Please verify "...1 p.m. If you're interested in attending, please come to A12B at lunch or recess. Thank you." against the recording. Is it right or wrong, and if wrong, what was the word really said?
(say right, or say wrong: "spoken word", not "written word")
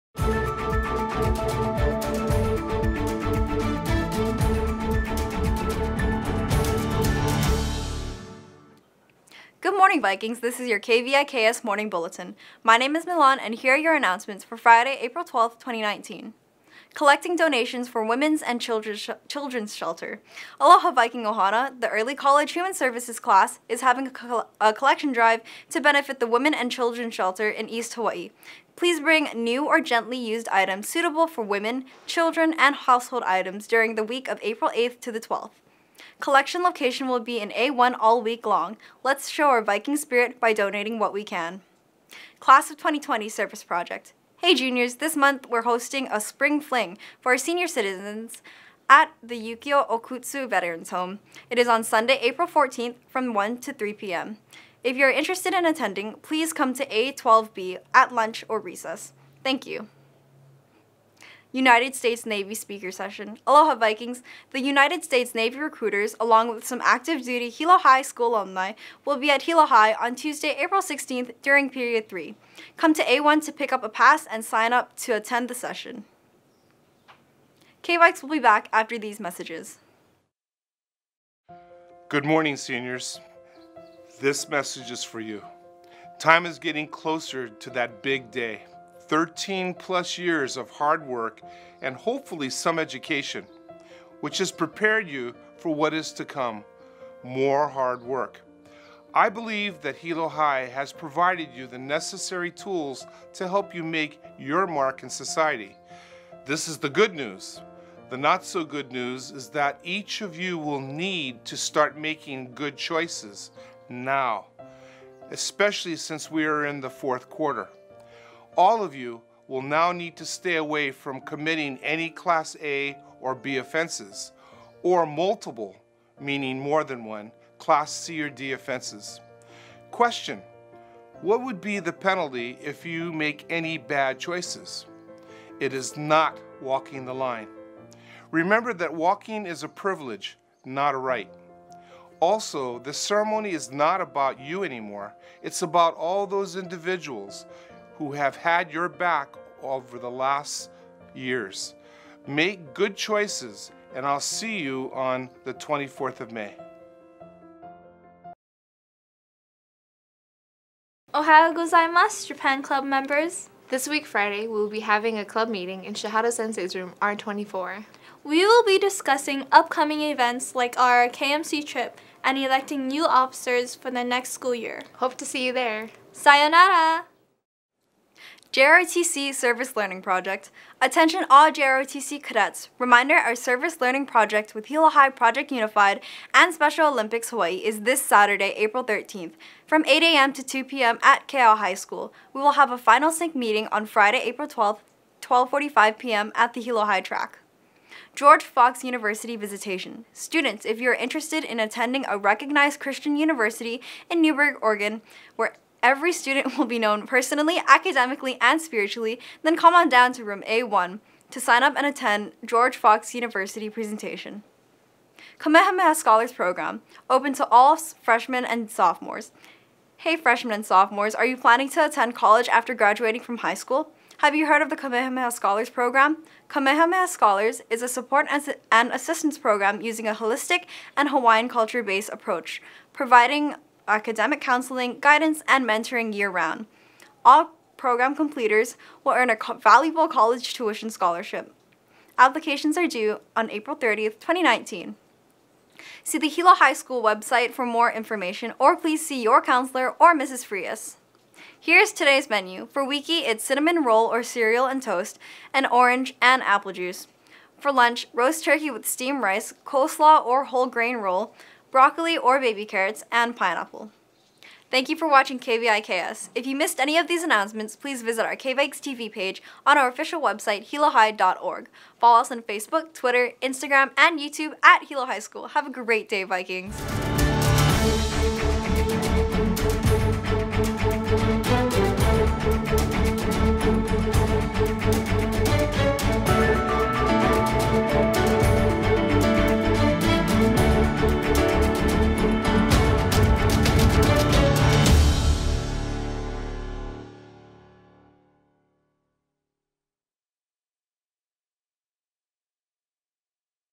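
wrong: "3", not "1".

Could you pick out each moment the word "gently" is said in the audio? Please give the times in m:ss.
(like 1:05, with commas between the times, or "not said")
0:29.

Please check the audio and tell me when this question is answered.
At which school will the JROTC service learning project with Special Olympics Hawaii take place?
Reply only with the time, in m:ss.
3:11.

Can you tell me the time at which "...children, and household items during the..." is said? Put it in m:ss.
0:32.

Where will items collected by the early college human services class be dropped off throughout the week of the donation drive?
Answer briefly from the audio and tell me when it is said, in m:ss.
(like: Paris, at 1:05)
A1, at 0:37.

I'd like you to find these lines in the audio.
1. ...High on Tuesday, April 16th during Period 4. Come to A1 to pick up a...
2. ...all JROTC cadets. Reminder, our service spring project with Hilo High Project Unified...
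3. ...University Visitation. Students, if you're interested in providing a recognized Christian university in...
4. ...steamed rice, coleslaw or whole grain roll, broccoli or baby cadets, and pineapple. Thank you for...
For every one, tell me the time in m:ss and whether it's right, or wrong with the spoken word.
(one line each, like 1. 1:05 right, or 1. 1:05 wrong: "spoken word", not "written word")
1. 1:09 wrong: "3", not "4"
2. 3:01 wrong: "learning", not "spring"
3. 3:18 wrong: "attending", not "providing"
4. 4:18 wrong: "carrots", not "cadets".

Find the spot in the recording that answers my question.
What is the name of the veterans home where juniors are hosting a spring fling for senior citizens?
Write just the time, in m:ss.
0:49.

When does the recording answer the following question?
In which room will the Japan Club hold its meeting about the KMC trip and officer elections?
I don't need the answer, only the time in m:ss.
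2:47.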